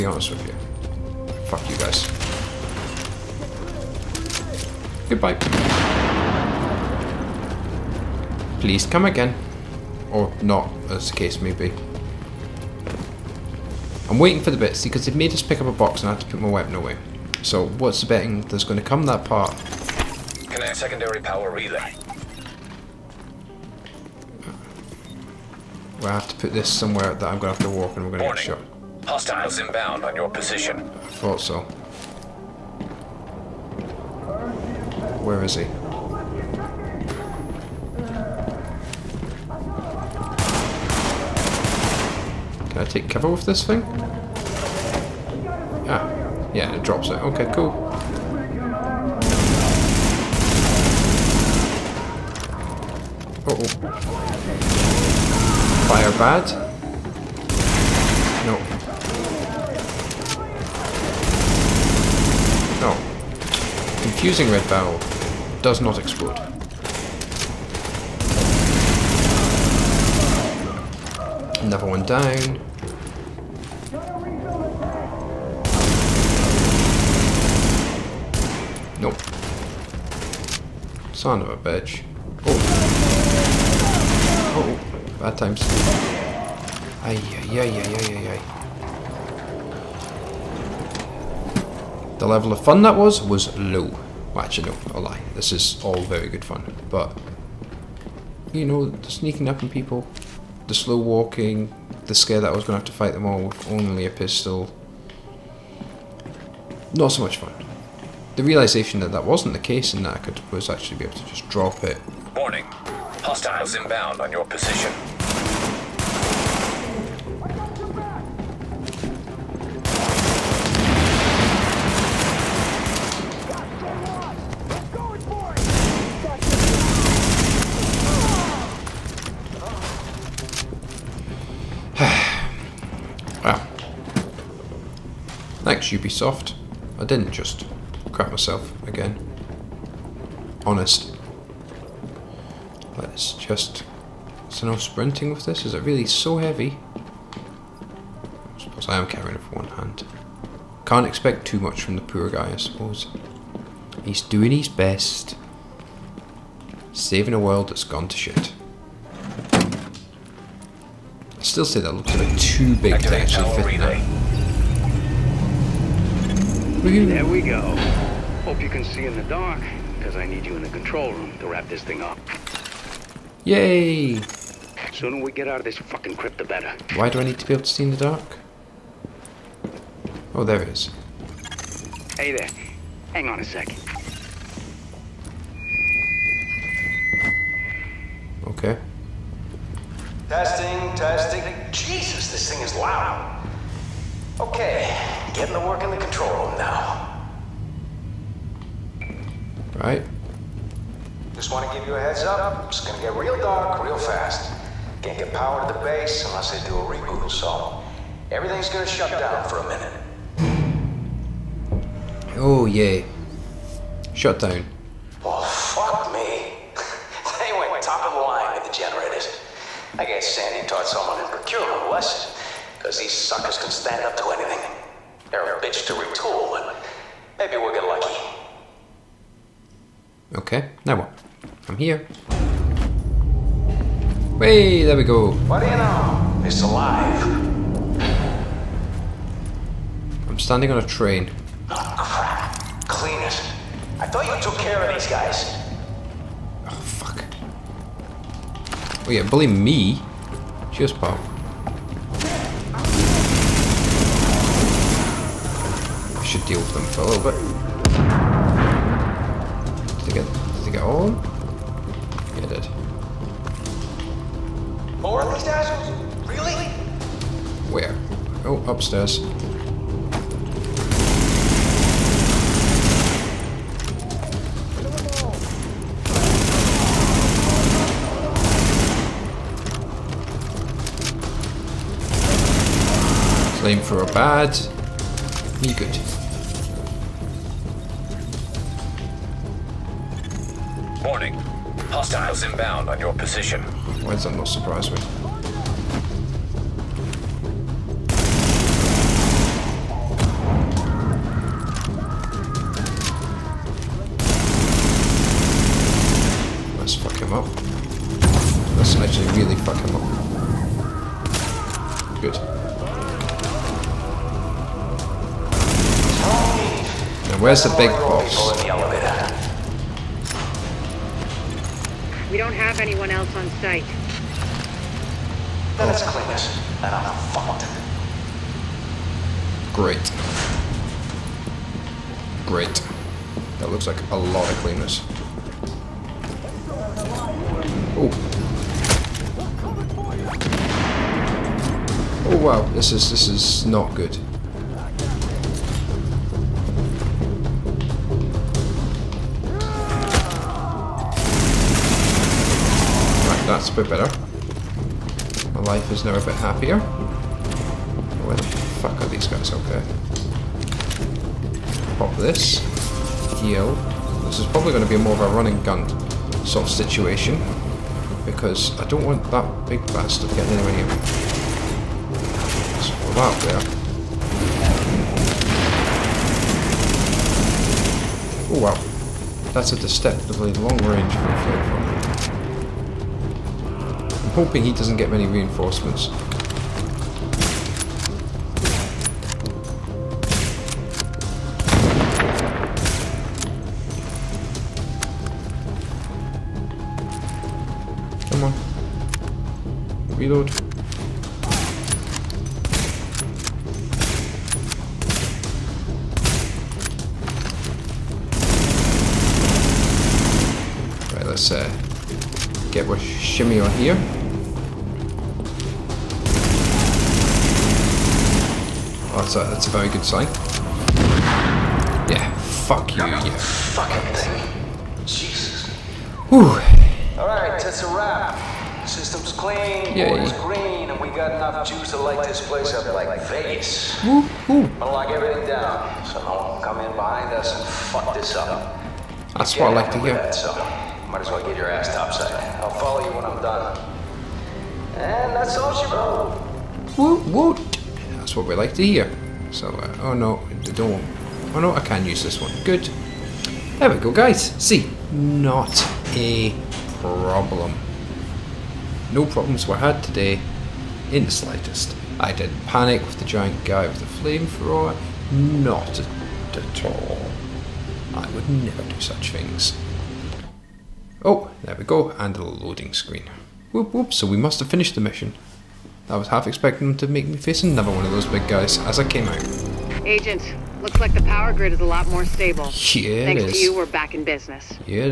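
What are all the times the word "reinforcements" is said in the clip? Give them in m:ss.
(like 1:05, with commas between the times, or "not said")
6:25.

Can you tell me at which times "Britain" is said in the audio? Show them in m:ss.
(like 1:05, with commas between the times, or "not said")
not said.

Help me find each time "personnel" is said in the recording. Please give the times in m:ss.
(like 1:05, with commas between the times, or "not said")
not said.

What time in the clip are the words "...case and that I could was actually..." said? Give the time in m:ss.
1:49.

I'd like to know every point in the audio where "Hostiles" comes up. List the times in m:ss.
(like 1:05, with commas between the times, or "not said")
0:29, 1:53, 4:51.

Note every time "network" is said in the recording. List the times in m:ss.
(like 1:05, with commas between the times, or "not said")
not said.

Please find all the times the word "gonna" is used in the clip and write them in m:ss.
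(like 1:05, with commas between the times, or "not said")
3:22, 3:28, 7:14.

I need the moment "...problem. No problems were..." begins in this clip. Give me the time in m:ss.
7:37.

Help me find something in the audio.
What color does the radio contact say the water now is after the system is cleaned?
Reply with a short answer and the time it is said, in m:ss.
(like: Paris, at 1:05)
Green, at 7:10.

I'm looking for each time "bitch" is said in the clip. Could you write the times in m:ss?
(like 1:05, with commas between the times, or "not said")
1:21, 3:45.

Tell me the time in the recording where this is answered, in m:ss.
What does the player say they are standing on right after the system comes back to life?
4:00.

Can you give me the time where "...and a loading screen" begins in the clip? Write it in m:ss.
7:52.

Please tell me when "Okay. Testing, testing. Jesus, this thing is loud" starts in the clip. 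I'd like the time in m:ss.
3:08.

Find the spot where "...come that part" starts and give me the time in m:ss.
0:18.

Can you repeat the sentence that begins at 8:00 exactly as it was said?
Agent, looks like the power grid is a lot more stable.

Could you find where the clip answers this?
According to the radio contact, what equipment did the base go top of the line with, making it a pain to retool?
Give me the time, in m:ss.
3:38.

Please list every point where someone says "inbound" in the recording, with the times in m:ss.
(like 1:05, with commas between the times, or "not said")
0:29, 1:53, 4:52.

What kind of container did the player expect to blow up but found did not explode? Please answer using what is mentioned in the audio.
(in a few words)
Red barrel.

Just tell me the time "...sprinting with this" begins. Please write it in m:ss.
2:24.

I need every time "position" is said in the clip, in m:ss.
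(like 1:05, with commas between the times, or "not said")
0:30, 1:54, 4:53.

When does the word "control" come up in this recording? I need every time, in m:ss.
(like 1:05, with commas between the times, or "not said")
2:50, 3:15.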